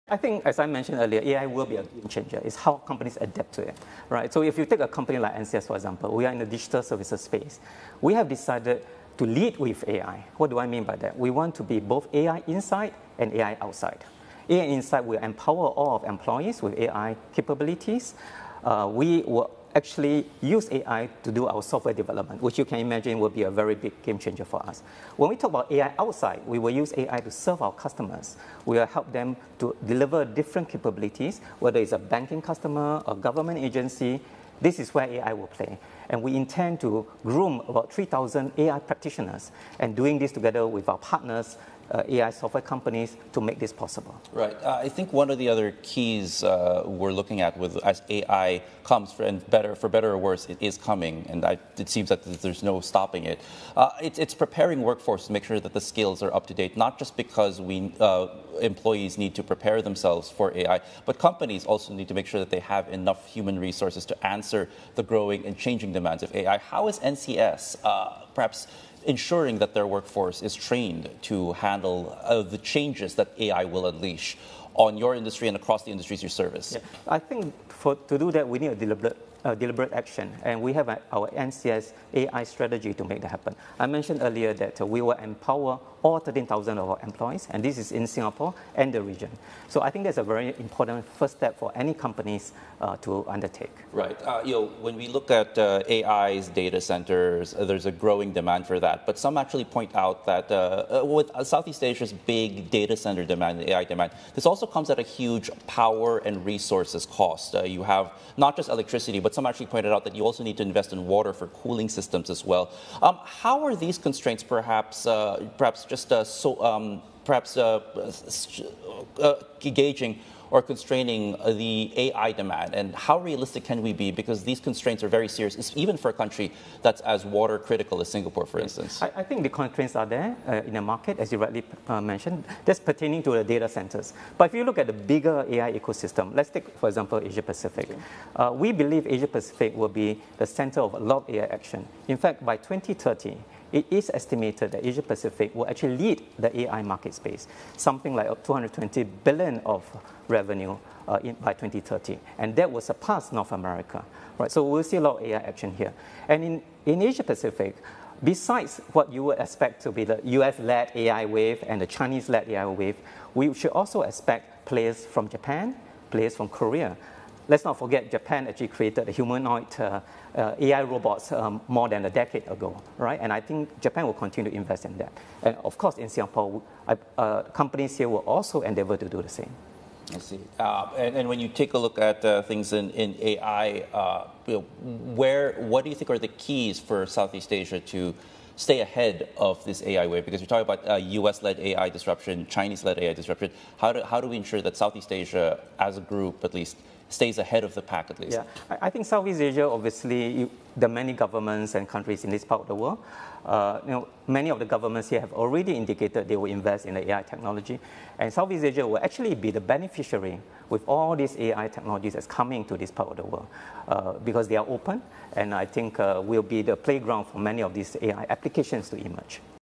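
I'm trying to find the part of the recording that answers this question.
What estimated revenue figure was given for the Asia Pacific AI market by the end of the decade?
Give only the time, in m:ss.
2:28.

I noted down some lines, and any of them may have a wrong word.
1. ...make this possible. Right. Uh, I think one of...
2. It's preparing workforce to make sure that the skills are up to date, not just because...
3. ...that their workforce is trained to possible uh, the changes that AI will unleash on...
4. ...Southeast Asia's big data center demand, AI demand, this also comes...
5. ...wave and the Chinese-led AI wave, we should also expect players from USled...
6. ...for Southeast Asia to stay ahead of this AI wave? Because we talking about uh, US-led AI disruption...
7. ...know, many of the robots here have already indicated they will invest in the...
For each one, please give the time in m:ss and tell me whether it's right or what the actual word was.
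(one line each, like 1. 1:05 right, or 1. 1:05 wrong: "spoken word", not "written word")
1. 0:43 right
2. 0:54 right
3. 1:09 wrong: "handle", not "possible"
4. 1:41 right
5. 2:41 wrong: "Japan", not "USled"
6. 3:06 right
7. 3:23 wrong: "governments", not "robots".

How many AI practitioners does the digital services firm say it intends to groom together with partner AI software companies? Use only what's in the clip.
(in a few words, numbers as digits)
3,000.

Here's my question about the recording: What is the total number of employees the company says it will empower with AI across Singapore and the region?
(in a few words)
13,000.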